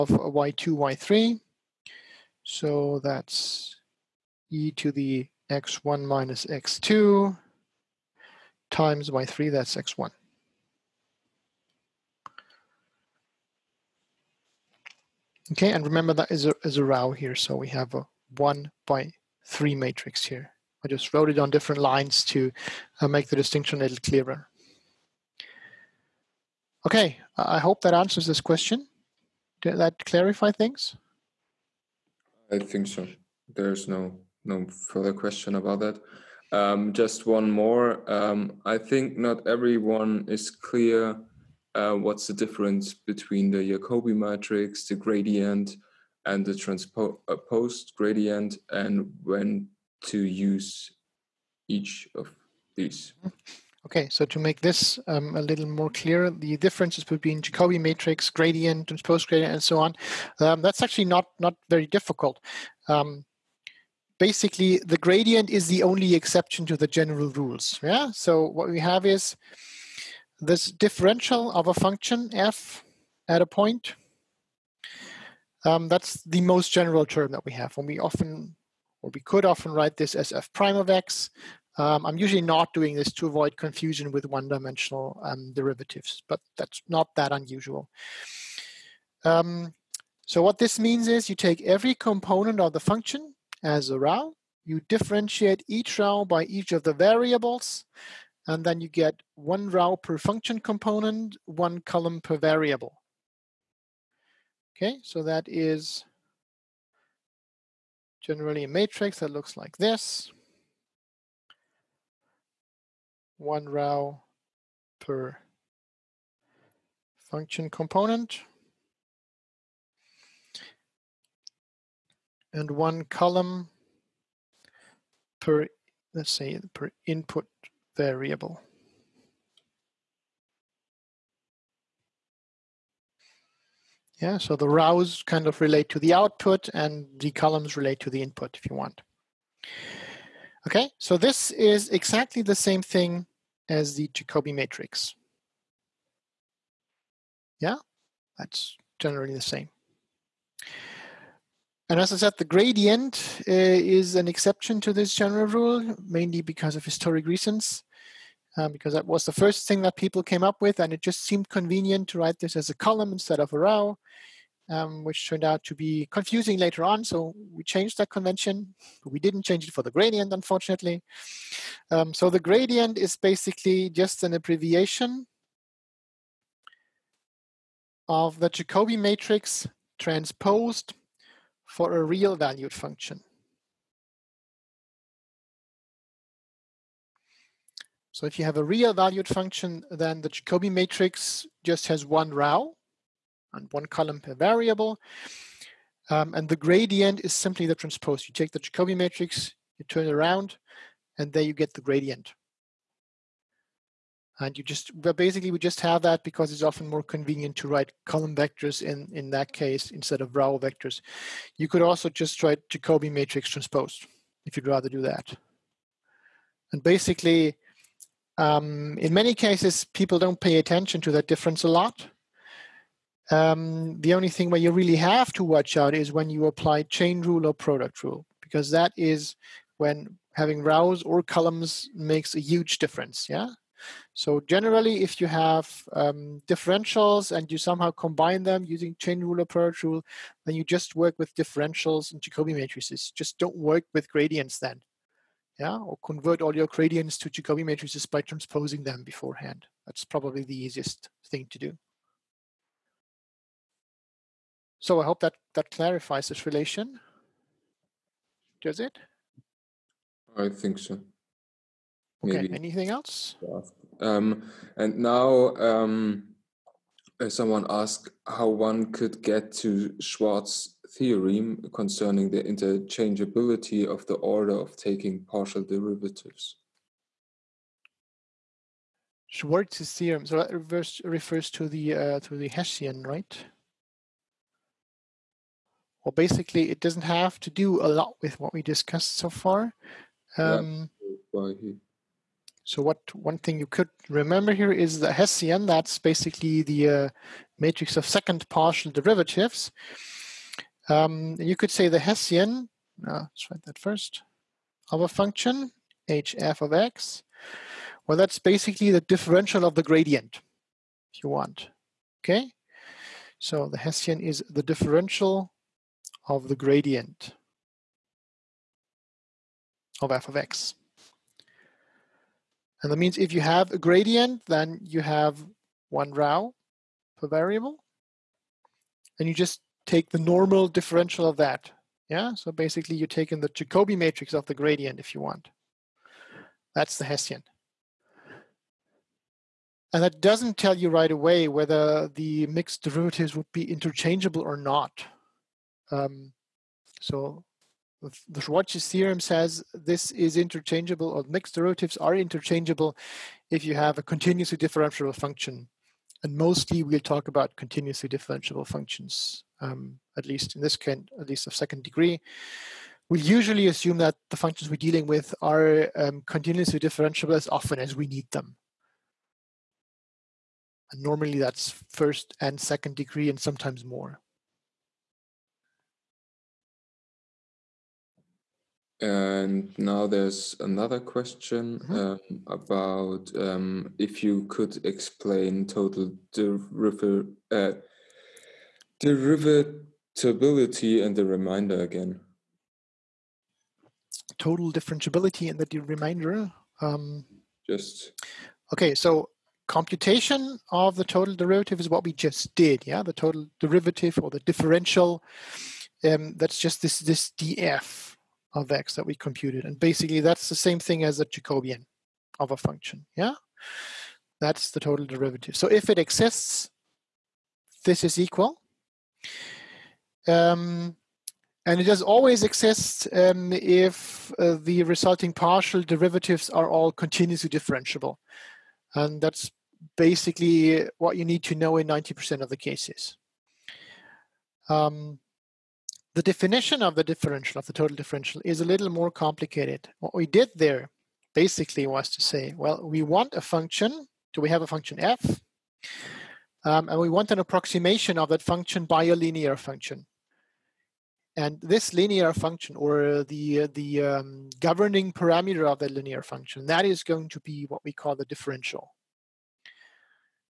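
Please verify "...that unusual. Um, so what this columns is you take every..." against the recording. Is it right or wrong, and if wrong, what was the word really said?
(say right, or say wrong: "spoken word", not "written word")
wrong: "means", not "columns".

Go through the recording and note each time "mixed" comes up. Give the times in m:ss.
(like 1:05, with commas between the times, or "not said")
5:42, 5:51.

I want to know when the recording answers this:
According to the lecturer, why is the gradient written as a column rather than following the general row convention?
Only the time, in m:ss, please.
2:36.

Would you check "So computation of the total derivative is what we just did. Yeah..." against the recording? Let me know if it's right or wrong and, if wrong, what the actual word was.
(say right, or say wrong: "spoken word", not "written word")
right.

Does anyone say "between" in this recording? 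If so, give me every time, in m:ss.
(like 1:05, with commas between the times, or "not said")
0:42, 0:57.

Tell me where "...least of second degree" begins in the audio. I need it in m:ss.
6:01.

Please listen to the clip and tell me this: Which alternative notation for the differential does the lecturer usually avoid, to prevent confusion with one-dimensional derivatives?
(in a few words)
f prime of x.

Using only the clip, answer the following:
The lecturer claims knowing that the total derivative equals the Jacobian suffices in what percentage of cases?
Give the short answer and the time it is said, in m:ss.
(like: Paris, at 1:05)
90%, at 7:11.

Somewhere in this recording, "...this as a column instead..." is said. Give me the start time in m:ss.
2:42.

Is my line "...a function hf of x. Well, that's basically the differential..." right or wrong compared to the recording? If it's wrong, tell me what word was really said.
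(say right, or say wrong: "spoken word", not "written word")
right.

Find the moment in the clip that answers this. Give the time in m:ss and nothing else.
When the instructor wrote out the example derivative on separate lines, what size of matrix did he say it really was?
0:18.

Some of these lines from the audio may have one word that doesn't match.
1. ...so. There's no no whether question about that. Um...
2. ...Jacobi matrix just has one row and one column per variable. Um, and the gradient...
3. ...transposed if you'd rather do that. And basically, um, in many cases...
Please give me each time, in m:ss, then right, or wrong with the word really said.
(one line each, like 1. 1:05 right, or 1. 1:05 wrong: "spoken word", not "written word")
1. 0:32 wrong: "further", not "whether"
2. 3:10 right
3. 3:33 right.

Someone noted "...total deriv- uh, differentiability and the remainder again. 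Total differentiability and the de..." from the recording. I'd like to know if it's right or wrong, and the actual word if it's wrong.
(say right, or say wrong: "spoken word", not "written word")
wrong: "derivatability", not "differentiability".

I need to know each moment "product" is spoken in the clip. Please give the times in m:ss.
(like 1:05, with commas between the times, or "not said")
3:47, 3:59.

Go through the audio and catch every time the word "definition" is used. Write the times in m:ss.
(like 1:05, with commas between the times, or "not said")
7:16.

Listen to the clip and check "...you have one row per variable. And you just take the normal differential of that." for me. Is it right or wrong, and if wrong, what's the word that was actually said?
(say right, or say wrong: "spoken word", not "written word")
right.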